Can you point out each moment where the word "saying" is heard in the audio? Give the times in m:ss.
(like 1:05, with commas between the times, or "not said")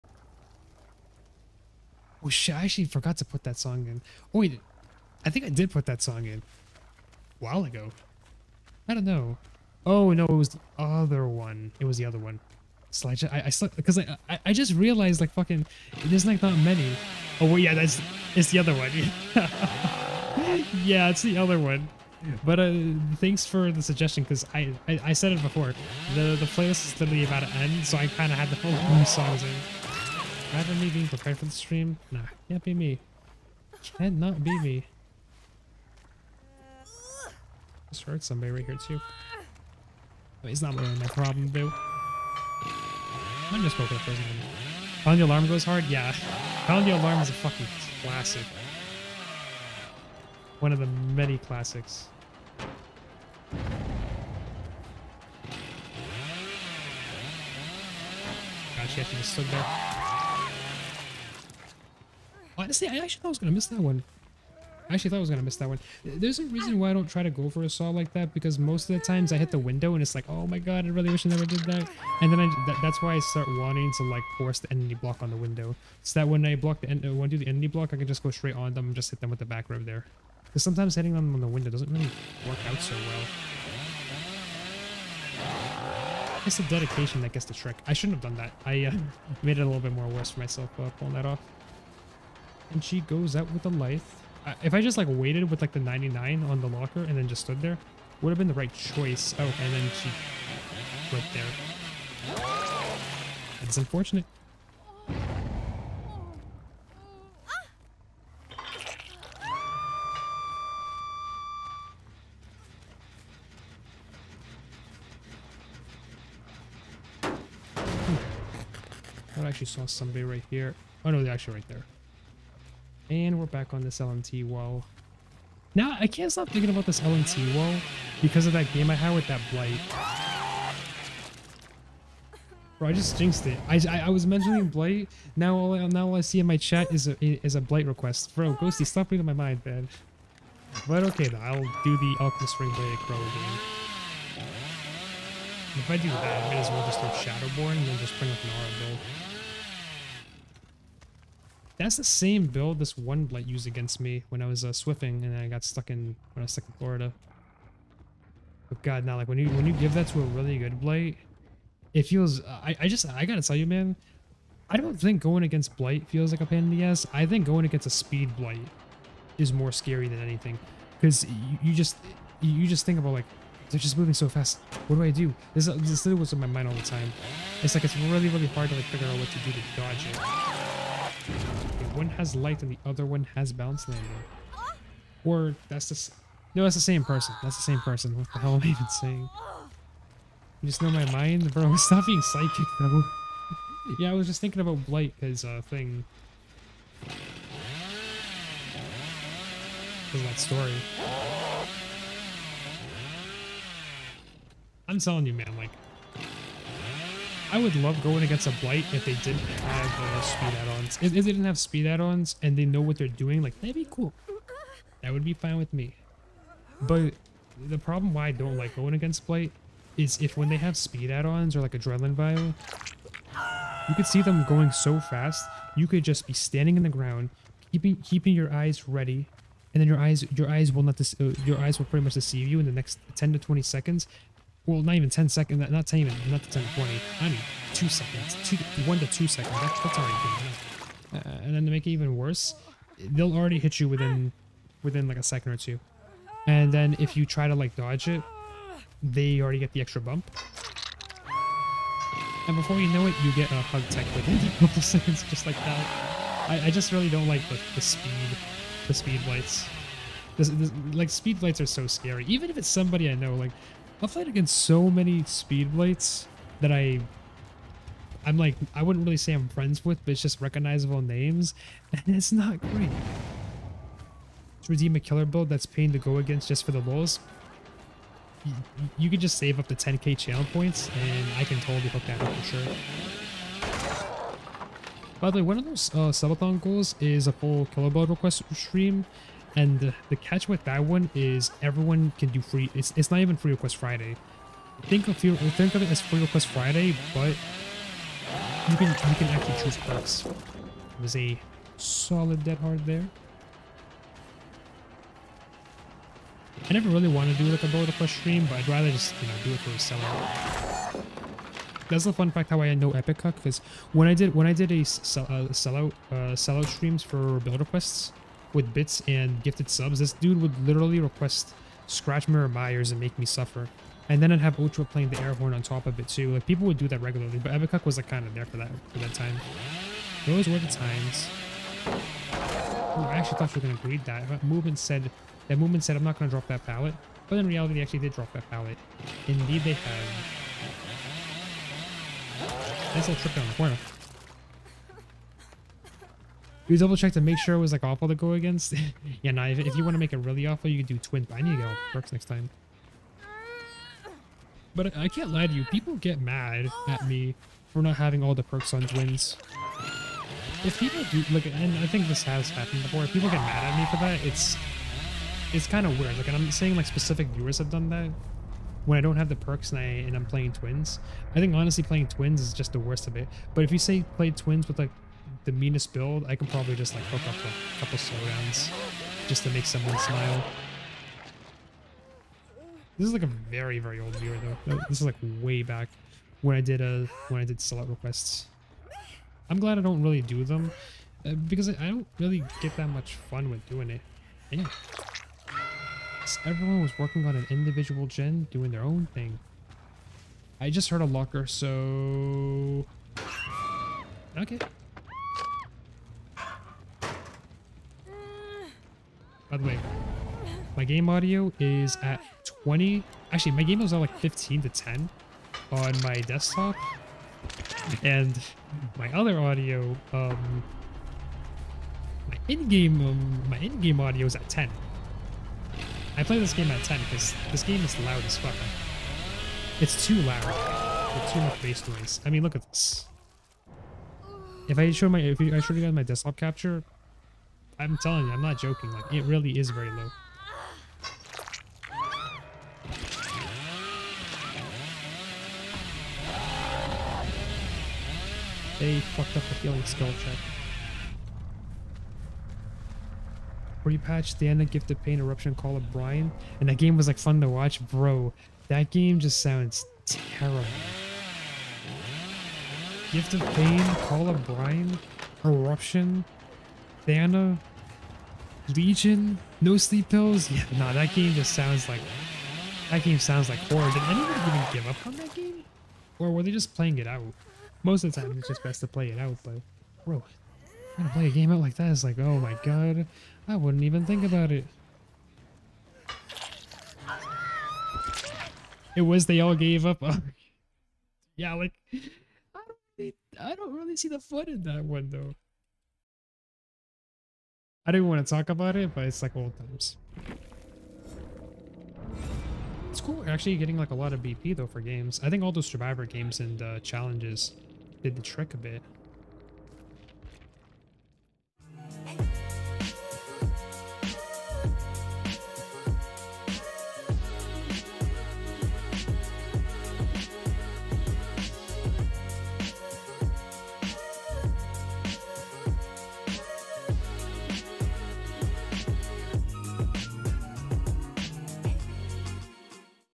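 3:08, 6:06.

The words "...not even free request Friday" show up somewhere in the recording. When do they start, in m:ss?
4:53.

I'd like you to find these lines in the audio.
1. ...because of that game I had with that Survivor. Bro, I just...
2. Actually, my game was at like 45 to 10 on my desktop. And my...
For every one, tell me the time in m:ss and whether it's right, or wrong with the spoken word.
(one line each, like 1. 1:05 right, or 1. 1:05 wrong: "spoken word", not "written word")
1. 2:08 wrong: "Blight", not "Survivor"
2. 6:53 wrong: "15", not "45".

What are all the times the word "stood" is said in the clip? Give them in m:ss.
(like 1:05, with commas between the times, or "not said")
0:59, 1:37.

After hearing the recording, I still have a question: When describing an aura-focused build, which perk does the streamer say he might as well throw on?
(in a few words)
Shadowborn.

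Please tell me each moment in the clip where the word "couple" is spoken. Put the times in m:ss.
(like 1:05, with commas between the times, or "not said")
4:14, 6:17.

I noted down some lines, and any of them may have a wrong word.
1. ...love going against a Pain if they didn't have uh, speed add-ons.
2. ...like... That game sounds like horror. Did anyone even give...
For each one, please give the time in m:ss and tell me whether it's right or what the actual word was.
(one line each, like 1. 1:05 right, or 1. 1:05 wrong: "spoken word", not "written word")
1. 3:27 wrong: "Blight", not "Pain"
2. 7:51 right.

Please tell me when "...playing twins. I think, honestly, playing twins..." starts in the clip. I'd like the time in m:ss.
6:10.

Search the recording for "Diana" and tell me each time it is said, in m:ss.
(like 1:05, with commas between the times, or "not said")
7:34, 7:47.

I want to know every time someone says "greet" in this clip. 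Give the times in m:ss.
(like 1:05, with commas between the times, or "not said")
5:33.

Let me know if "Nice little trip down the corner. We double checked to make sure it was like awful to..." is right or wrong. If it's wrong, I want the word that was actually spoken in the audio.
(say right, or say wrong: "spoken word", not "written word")
right.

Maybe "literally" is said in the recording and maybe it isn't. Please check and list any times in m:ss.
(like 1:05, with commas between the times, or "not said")
0:26, 2:56, 5:20.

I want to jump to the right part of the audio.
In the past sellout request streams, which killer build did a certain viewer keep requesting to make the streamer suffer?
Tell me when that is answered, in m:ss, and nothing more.
5:21.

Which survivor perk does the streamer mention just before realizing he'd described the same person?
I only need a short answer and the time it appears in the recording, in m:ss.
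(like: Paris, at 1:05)
Balanced Landing, at 3:03.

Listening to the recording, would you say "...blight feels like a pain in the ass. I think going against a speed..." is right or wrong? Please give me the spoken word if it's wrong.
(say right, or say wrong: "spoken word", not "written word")
right.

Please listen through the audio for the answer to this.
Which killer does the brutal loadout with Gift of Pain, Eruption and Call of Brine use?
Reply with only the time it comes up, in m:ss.
7:48.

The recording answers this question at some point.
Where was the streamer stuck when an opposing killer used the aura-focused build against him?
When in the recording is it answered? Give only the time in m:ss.
2:36.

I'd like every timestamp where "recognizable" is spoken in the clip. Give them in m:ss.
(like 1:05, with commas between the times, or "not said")
4:30.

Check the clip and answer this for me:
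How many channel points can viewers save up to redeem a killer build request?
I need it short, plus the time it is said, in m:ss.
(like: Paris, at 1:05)
10k, at 4:39.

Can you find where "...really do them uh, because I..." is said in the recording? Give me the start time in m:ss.
6:30.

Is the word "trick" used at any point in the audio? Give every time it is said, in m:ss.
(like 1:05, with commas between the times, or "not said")
1:27, 8:28.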